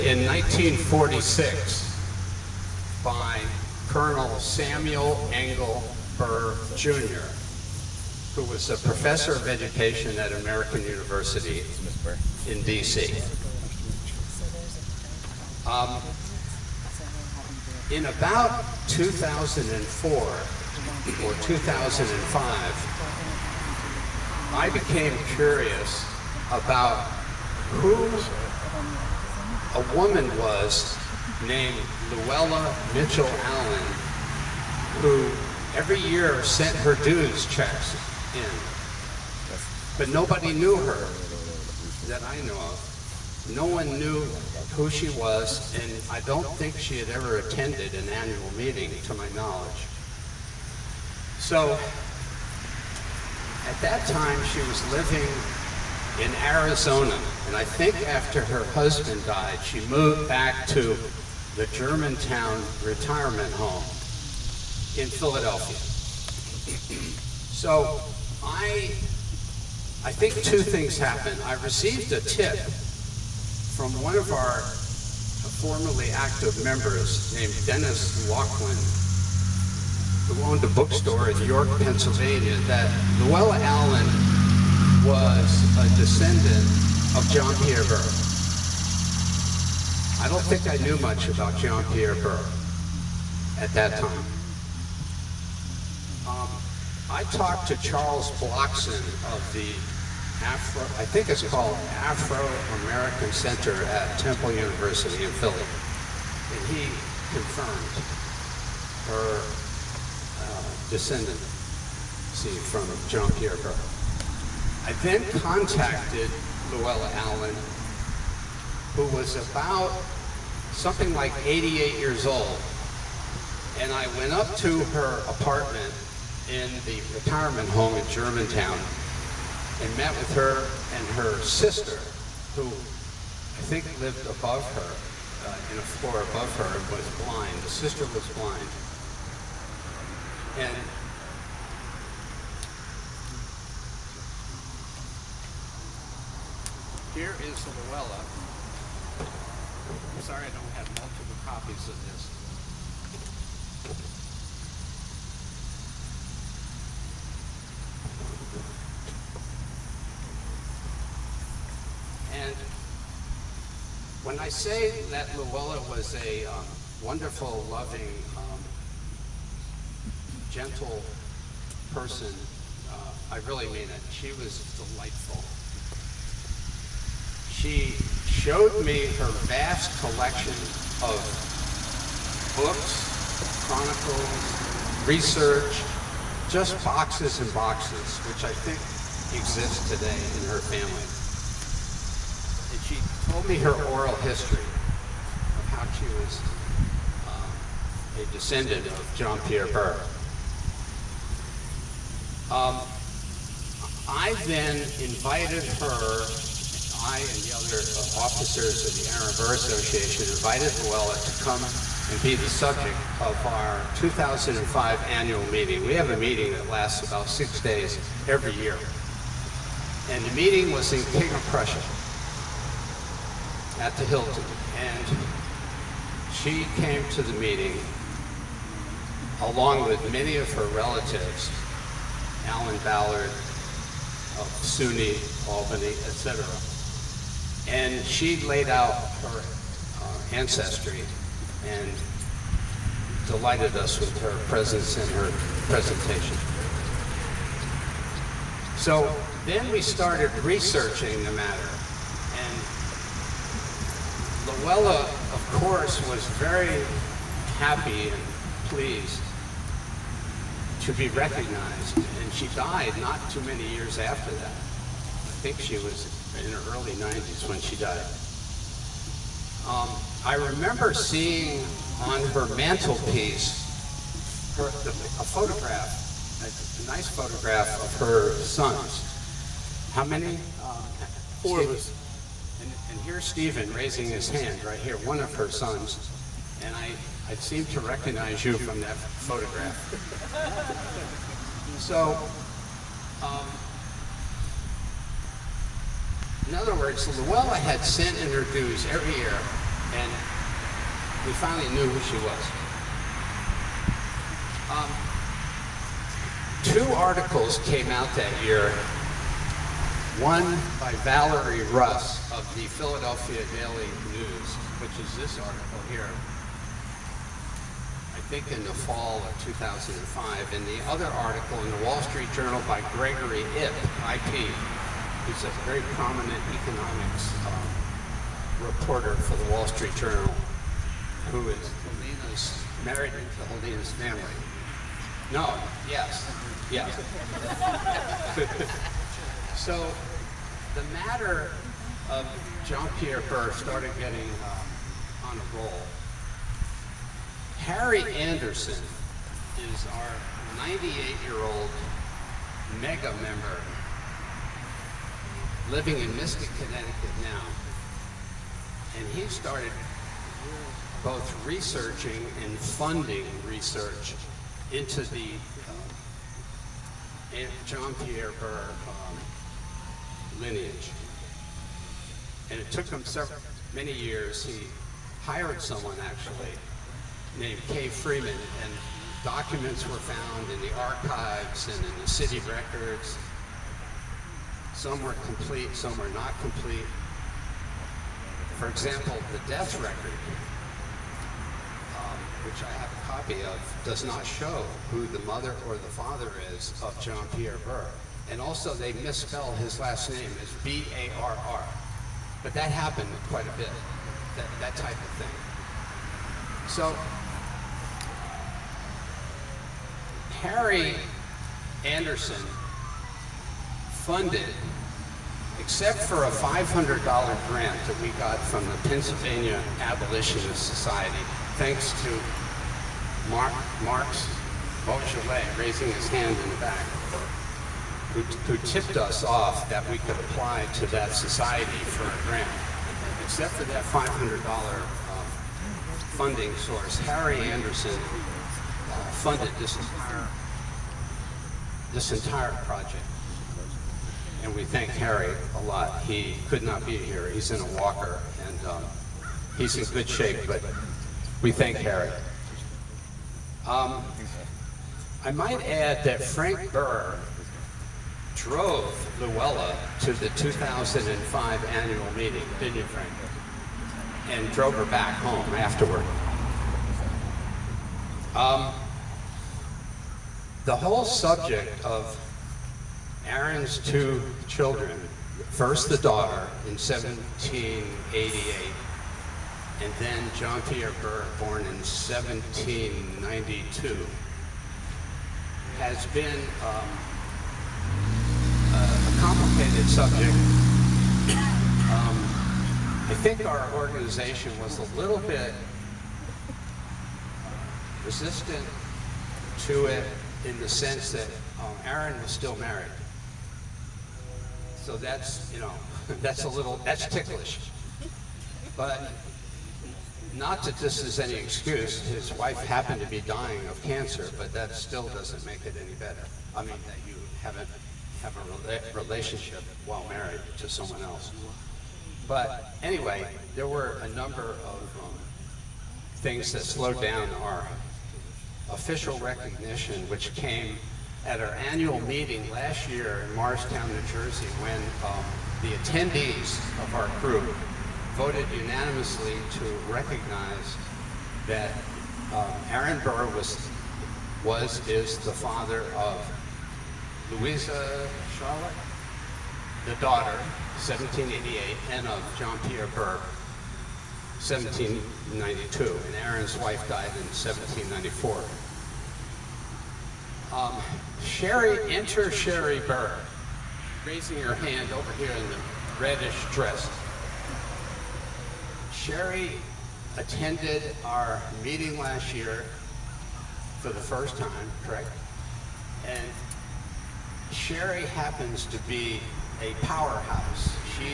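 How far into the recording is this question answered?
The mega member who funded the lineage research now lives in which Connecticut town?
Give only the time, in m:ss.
5:56.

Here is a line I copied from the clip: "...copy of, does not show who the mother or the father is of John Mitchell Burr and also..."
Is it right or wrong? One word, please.
wrong.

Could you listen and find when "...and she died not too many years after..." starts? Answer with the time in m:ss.
4:21.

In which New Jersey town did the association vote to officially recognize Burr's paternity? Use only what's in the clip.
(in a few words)
Morristown.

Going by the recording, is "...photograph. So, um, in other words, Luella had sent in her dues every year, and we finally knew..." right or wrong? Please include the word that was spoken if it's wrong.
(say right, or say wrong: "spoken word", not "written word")
right.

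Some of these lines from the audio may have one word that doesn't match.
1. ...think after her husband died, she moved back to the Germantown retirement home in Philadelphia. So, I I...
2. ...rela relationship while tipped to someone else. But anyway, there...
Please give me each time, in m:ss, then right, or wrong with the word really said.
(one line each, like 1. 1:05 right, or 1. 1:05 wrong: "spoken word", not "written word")
1. 0:57 right
2. 8:38 wrong: "married", not "tipped".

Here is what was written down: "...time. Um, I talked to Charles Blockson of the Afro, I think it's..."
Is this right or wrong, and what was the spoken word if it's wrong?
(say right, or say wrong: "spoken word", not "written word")
right.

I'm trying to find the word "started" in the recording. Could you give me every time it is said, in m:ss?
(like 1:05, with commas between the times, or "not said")
4:09, 5:43, 5:59.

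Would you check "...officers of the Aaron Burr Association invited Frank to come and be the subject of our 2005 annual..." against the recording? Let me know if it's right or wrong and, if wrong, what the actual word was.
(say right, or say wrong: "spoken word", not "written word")
wrong: "Luella", not "Frank".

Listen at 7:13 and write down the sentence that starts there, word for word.
Except for that $500 uh, funding source, Harry Anderson uh, funded this entire, this entire project.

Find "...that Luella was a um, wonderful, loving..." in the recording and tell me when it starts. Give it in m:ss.
2:45.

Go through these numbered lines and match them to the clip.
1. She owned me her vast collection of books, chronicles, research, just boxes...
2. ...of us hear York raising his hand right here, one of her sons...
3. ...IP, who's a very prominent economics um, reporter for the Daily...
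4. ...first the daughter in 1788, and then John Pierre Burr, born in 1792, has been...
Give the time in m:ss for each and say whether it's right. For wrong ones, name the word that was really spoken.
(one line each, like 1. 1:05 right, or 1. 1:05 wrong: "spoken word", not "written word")
1. 2:57 wrong: "showed", not "owned"
2. 4:41 wrong: "Stephen", not "York"
3. 5:24 wrong: "Wall", not "Daily"
4. 7:55 right.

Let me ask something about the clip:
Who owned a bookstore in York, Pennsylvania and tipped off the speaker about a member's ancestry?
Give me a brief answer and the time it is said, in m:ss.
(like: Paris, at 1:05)
Dennis Laughlin, at 1:17.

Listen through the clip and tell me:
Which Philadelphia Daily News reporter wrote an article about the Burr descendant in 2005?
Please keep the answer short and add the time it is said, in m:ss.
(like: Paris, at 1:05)
Valerie Russ, at 5:11.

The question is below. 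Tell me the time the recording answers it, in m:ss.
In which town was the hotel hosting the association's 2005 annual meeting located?
3:41.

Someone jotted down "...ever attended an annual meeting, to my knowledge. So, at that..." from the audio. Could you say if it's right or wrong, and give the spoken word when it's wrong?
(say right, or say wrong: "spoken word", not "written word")
right.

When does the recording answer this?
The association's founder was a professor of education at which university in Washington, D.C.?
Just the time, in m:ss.
0:10.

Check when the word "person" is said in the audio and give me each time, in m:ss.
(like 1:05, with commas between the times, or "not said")
2:51.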